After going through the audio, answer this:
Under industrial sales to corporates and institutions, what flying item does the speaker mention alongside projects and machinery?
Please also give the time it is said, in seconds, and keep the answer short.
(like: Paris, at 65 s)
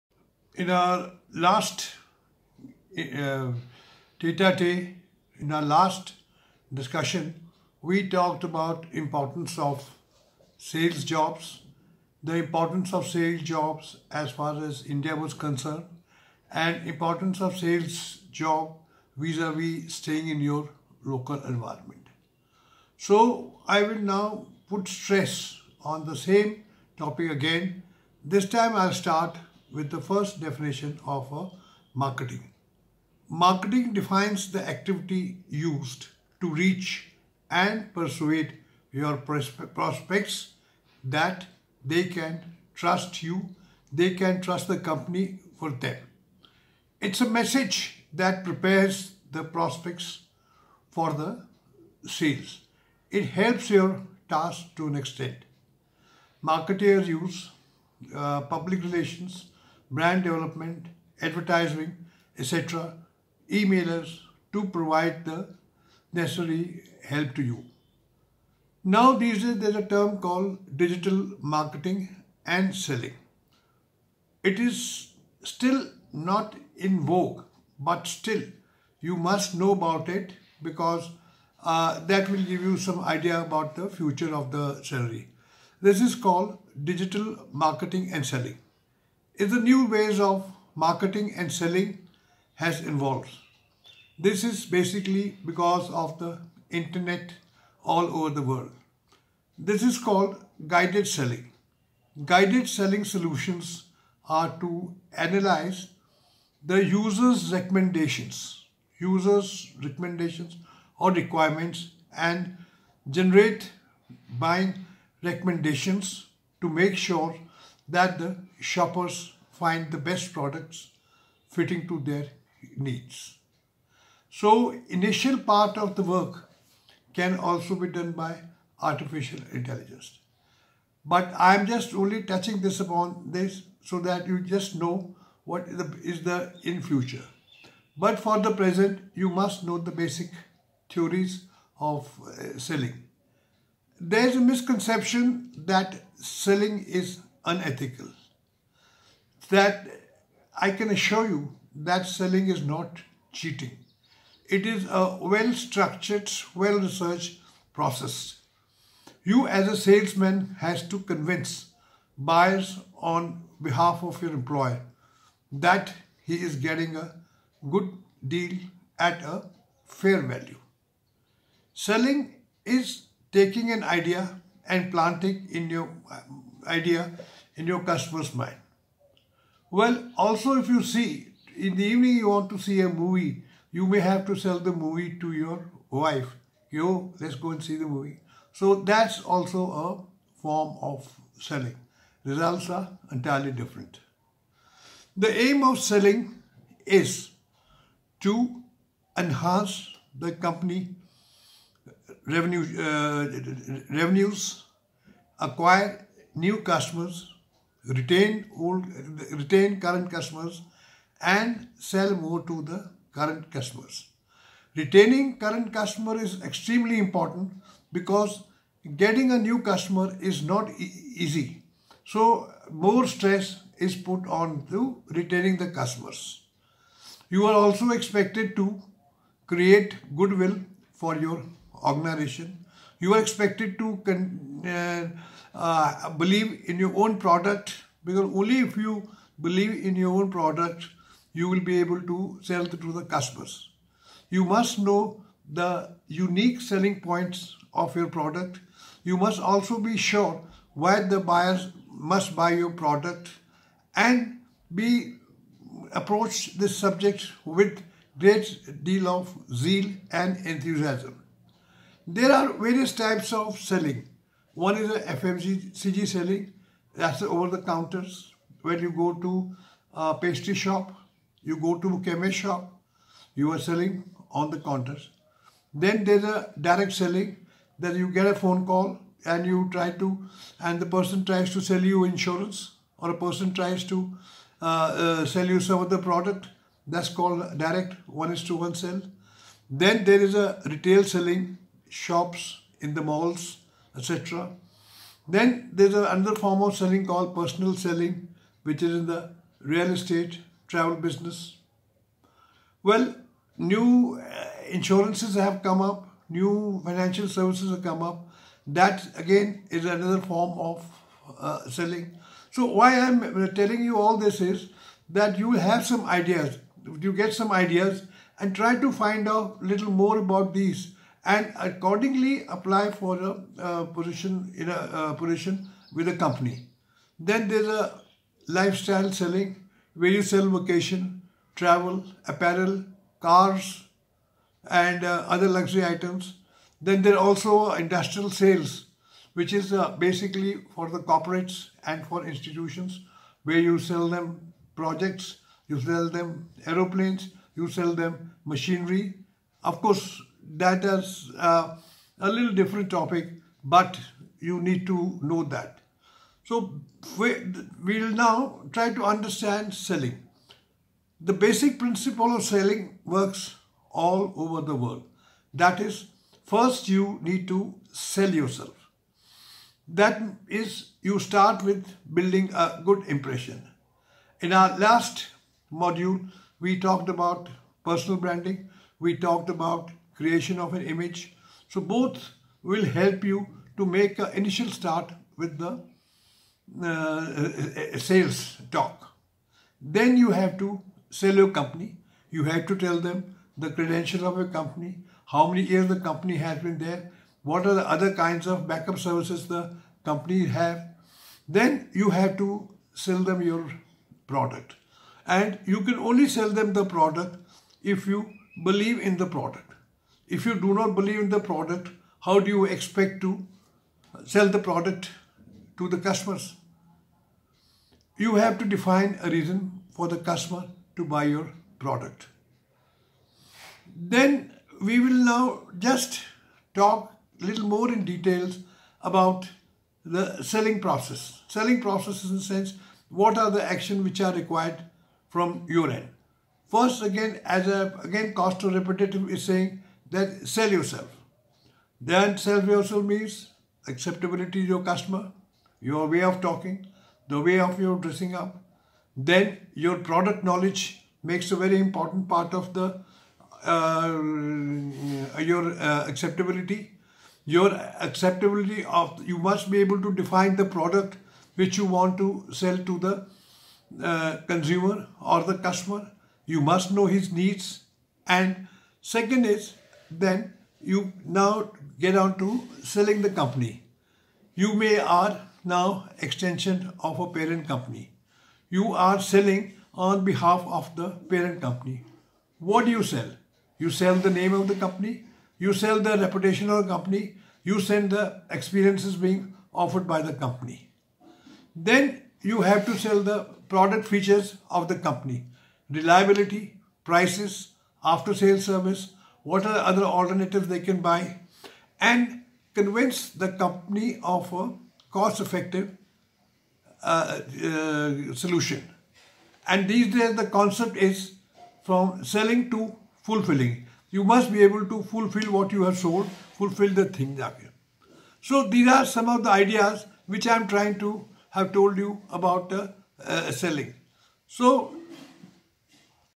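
Aeroplanes, at 346 s.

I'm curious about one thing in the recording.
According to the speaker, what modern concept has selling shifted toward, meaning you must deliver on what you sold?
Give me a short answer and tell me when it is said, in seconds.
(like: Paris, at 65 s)
Fulfilling, at 511 s.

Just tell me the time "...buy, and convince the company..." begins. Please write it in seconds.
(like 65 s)
501 s.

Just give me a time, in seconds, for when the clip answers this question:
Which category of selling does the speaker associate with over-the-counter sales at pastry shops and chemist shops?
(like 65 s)
264 s.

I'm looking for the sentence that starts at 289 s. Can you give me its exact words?
Then there is a retail selling shops, in the malls, etc.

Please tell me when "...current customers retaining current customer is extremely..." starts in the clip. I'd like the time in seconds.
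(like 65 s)
213 s.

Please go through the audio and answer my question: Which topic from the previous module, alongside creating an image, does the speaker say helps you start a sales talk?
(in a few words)
Personal branding.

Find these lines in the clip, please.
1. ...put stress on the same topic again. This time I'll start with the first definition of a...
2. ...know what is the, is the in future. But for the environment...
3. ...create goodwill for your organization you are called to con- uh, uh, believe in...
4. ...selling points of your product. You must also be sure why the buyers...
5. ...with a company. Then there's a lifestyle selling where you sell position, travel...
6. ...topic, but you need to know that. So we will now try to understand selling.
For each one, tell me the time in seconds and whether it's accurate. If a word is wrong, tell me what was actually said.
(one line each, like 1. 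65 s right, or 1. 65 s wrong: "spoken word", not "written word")
1. 24 s right
2. 134 s wrong: "present", not "environment"
3. 229 s wrong: "expected", not "called"
4. 246 s right
5. 325 s wrong: "vacation", not "position"
6. 352 s right.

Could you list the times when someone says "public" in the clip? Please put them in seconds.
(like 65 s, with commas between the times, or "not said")
58 s.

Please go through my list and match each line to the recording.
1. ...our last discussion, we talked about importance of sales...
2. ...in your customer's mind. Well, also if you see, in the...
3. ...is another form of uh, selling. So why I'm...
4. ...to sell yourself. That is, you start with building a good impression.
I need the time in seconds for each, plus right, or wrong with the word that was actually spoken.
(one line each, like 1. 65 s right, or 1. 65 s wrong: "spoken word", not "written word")
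1. 5 s right
2. 177 s right
3. 309 s right
4. 367 s right.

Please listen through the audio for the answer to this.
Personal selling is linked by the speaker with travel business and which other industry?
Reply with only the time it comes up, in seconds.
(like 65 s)
299 s.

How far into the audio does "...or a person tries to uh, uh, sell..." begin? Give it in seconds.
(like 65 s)
282 s.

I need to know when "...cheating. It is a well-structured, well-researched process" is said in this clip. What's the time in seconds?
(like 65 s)
153 s.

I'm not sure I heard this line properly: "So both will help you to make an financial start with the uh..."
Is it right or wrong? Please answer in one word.
wrong.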